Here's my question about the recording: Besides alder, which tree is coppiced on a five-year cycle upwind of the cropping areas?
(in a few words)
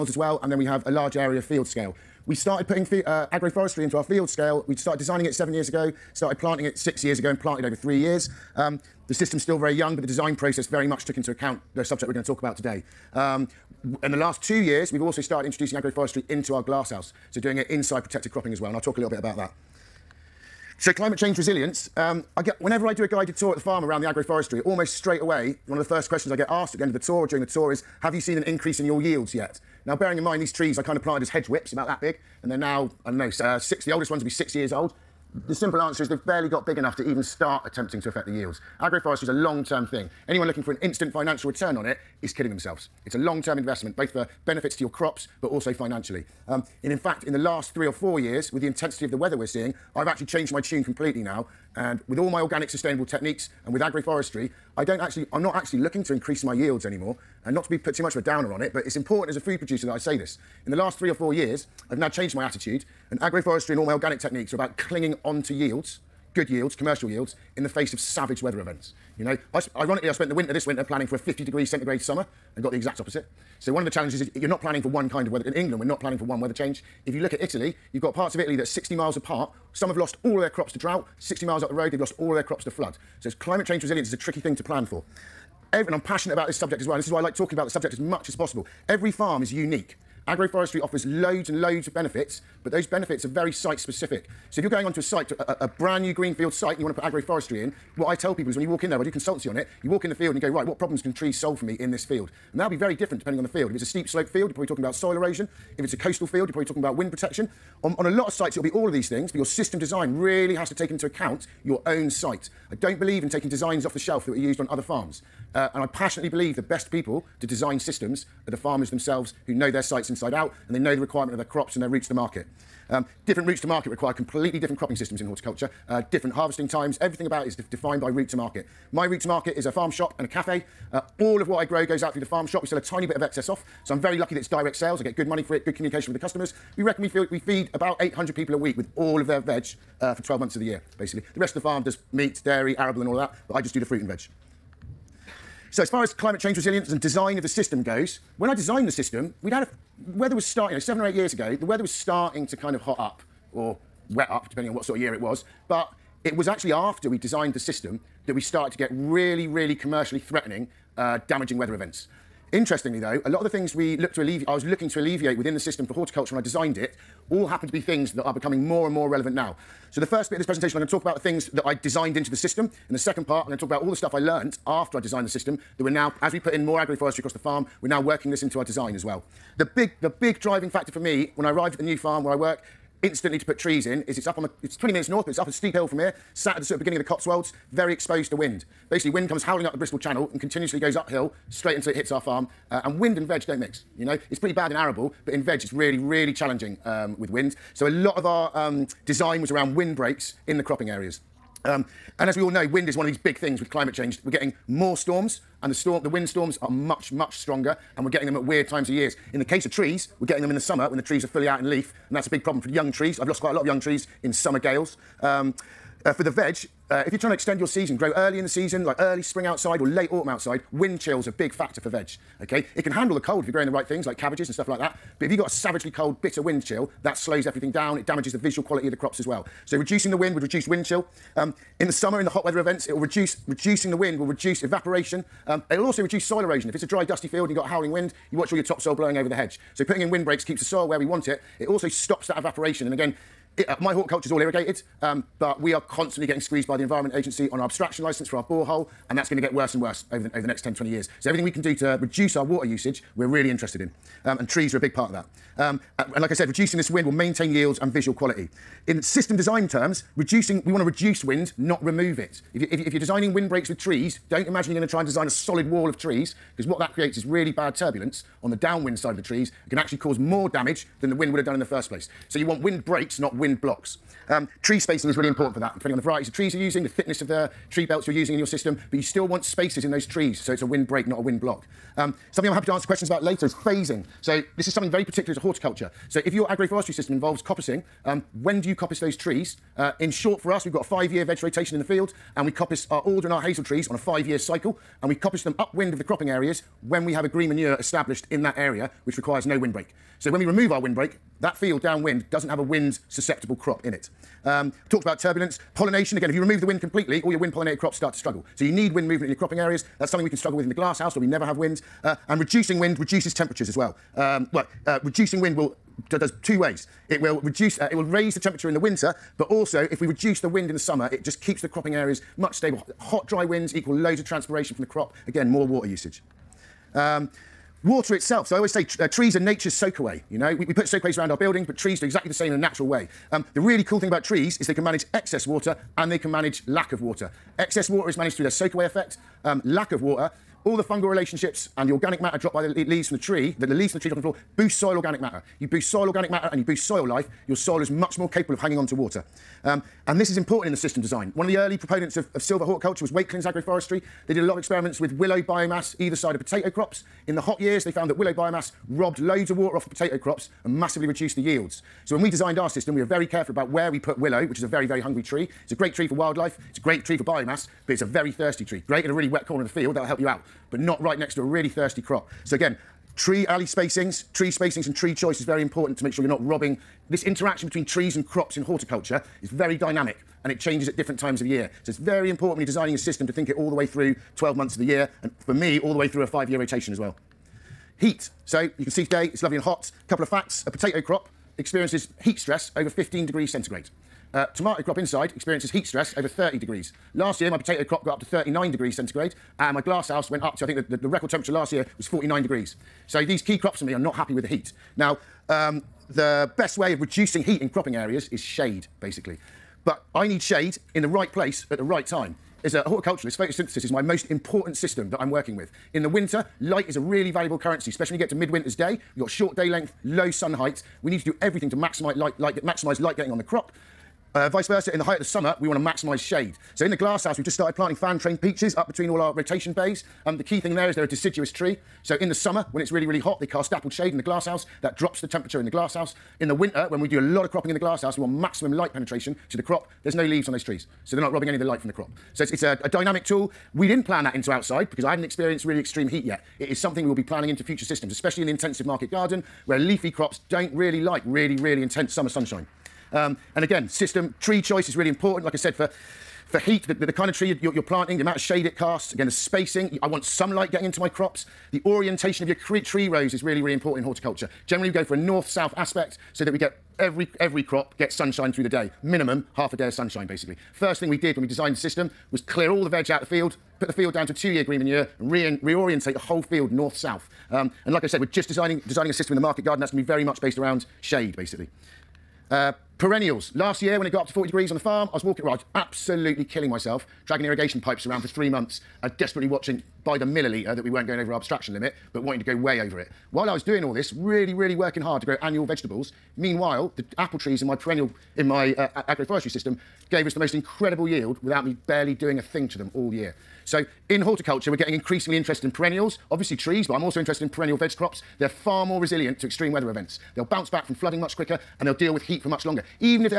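Hazel.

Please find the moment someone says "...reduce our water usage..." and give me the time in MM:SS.
04:11.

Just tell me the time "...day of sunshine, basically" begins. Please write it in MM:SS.
07:49.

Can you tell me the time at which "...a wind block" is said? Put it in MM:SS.
04:41.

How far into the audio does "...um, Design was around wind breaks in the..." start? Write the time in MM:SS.
03:18.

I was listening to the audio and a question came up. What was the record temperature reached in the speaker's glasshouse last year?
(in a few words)
49 degrees.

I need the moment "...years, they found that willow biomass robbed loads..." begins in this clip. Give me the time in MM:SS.
05:57.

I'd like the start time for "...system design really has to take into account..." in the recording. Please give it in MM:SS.
01:49.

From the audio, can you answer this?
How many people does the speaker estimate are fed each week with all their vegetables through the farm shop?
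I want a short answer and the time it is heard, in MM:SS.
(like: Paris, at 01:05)
800, at 02:17.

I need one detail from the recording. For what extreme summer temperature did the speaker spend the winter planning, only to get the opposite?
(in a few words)
50 degrees centigrade.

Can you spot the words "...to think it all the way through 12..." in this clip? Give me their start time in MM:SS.
06:23.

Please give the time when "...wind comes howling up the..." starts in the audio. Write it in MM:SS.
03:09.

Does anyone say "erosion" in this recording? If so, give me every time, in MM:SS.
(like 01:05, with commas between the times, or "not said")
01:45, 03:56.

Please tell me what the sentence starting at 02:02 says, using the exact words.
Um, Different routes to market require completely different cropping systems in horticulture, uh, different harvesting times.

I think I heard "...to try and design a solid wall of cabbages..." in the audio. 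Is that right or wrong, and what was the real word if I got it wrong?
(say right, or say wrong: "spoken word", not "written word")
wrong: "trees", not "cabbages".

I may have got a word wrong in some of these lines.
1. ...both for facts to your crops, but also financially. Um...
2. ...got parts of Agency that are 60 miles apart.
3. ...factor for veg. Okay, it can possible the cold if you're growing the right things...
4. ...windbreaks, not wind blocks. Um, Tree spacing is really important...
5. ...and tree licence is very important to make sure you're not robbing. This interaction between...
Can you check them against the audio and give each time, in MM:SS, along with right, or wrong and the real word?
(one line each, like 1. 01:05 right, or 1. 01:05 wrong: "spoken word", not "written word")
1. 00:43 wrong: "benefits", not "facts"
2. 01:18 wrong: "Italy", not "Agency"
3. 03:41 wrong: "handle", not "possible"
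4. 04:32 wrong: "breaks", not "windbreaks"
5. 06:14 wrong: "choice", not "licence".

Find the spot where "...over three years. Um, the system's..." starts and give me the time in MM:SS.
00:07.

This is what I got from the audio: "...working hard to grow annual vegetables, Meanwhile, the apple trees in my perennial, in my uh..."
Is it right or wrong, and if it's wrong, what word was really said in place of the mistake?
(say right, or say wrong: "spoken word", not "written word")
right.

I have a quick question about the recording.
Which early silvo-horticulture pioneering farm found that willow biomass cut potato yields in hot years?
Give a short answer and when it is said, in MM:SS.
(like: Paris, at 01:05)
Wakelyns Agroforestry, at 05:53.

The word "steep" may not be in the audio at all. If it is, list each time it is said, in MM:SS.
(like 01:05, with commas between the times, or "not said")
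01:43, 03:05.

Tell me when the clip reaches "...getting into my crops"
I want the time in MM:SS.
07:40.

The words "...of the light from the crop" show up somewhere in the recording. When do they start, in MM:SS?
07:21.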